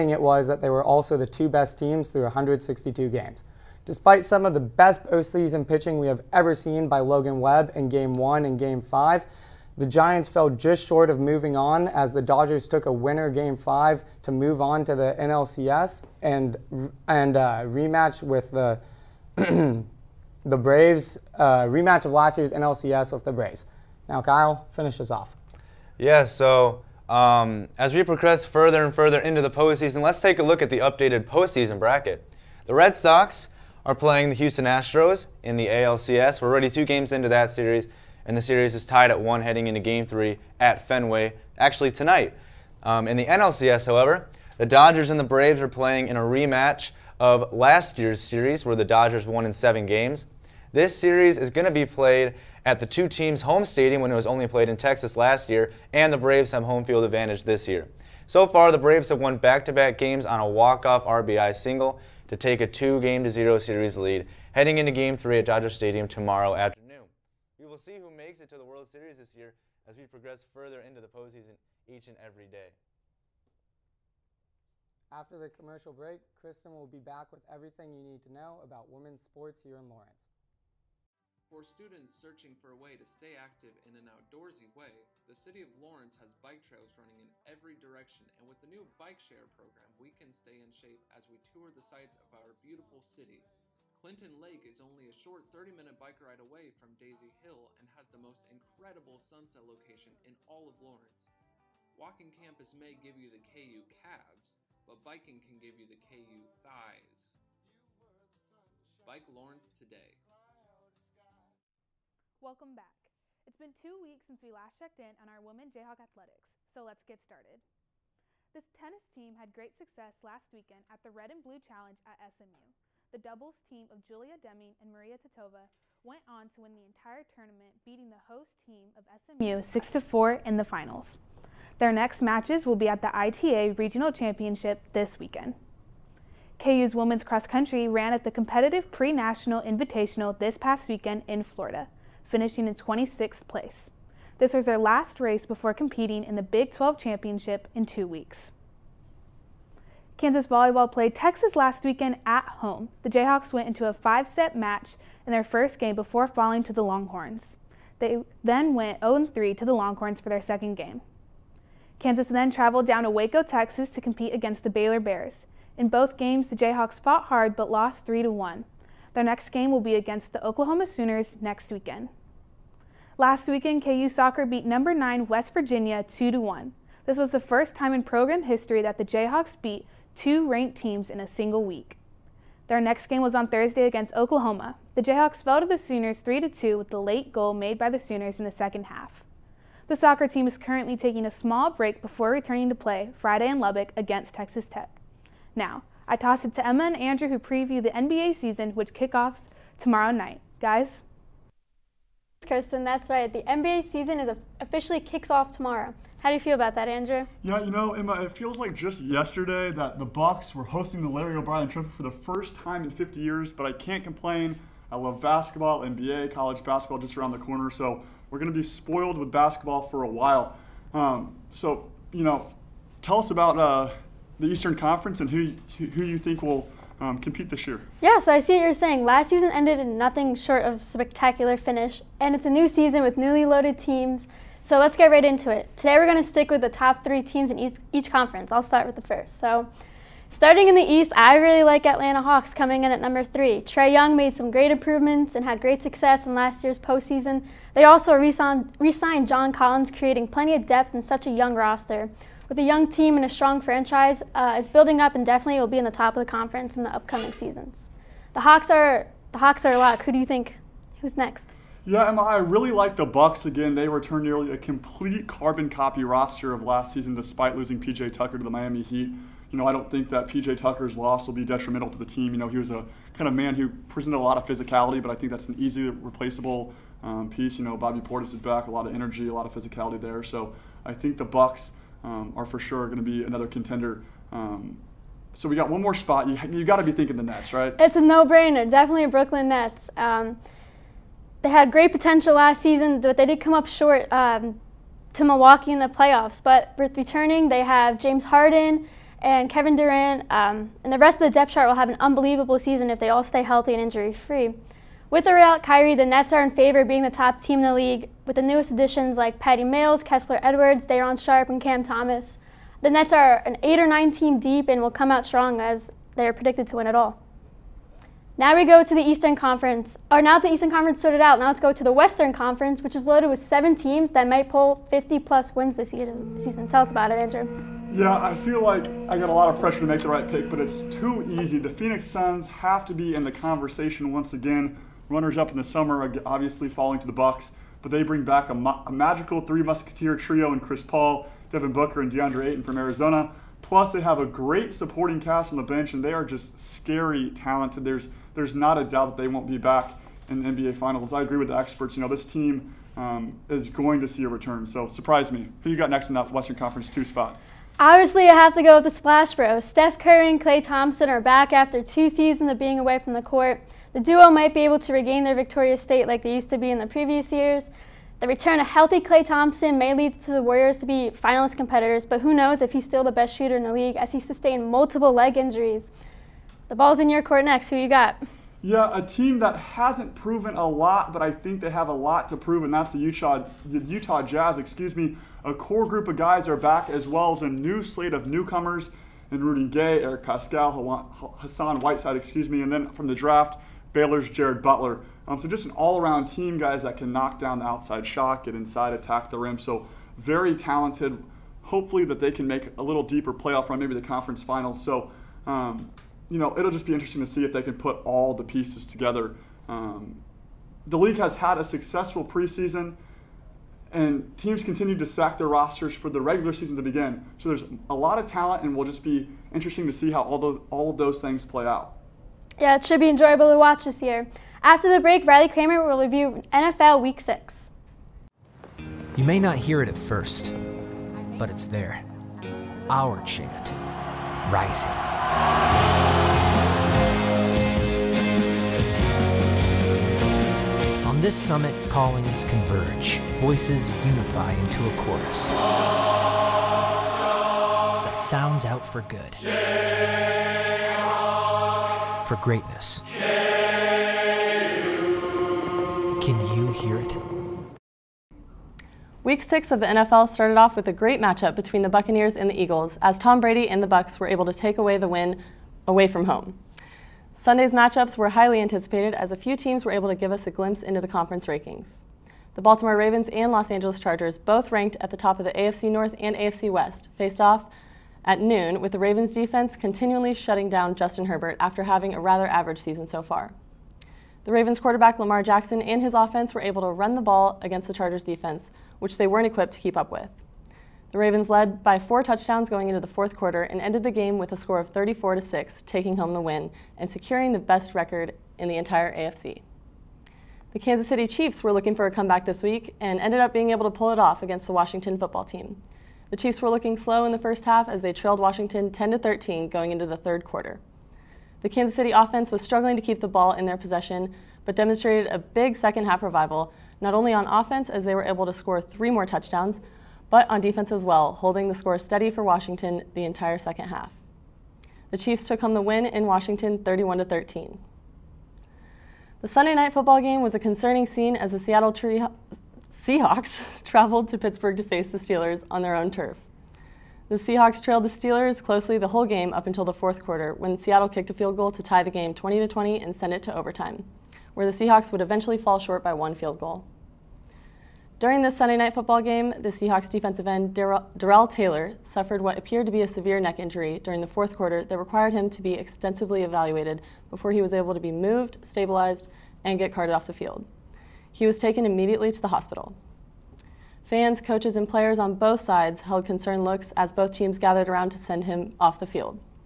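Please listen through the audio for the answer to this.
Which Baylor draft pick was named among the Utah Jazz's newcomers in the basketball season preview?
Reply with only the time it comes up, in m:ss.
6:34.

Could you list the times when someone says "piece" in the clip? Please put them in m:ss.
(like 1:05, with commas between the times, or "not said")
4:37, 6:48.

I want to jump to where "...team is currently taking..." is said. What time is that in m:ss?
3:10.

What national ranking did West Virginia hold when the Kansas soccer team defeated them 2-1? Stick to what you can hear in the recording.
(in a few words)
9.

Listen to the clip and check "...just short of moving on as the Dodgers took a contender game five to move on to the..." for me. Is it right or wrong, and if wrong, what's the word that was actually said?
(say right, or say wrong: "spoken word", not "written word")
wrong: "winner", not "contender".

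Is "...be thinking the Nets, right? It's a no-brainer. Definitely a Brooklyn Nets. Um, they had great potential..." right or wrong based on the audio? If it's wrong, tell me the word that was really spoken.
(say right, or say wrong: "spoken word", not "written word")
right.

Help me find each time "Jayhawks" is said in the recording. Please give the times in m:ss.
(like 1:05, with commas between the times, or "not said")
1:55, 2:33, 2:46, 2:59, 3:05.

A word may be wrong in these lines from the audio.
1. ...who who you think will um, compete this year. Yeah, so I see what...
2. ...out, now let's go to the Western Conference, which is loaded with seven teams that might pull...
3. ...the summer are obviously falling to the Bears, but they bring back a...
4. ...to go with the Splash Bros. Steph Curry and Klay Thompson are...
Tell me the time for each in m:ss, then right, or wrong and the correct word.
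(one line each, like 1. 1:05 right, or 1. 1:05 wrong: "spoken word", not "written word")
1. 3:45 right
2. 5:21 right
3. 5:35 wrong: "Bucks", not "Bears"
4. 5:58 right.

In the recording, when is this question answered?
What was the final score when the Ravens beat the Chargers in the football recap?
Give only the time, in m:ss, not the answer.
8:14.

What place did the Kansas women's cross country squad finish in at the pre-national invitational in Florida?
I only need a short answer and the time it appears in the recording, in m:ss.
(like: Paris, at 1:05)
26th, at 2:22.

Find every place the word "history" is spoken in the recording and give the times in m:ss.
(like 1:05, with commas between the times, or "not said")
2:58.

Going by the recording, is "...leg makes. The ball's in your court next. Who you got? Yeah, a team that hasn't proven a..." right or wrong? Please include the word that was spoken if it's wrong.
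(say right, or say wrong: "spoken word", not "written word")
wrong: "injuries", not "makes".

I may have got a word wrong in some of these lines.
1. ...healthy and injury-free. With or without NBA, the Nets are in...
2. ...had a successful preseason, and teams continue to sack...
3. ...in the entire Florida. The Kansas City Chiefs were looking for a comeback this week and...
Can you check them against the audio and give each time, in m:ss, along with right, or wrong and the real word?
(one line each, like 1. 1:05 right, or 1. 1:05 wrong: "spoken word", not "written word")
1. 5:03 wrong: "Kyrie", not "NBA"
2. 6:51 right
3. 8:18 wrong: "AFC", not "Florida".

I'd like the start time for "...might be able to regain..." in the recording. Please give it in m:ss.
6:04.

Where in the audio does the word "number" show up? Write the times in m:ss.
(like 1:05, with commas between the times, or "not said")
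2:54, 4:02.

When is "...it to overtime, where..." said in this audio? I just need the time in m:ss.
9:03.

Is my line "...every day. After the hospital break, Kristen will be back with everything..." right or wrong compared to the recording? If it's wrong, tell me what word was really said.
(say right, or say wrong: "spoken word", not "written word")
wrong: "commercial", not "hospital".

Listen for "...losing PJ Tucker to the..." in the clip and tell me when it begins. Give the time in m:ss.
4:27.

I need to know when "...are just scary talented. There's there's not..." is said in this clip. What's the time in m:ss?
5:46.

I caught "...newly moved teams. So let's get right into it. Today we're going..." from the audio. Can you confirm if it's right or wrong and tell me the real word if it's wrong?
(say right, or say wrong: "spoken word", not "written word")
wrong: "loaded", not "moved".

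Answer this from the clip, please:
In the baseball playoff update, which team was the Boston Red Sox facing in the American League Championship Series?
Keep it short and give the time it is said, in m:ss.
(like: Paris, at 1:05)
Houston Astros, at 0:34.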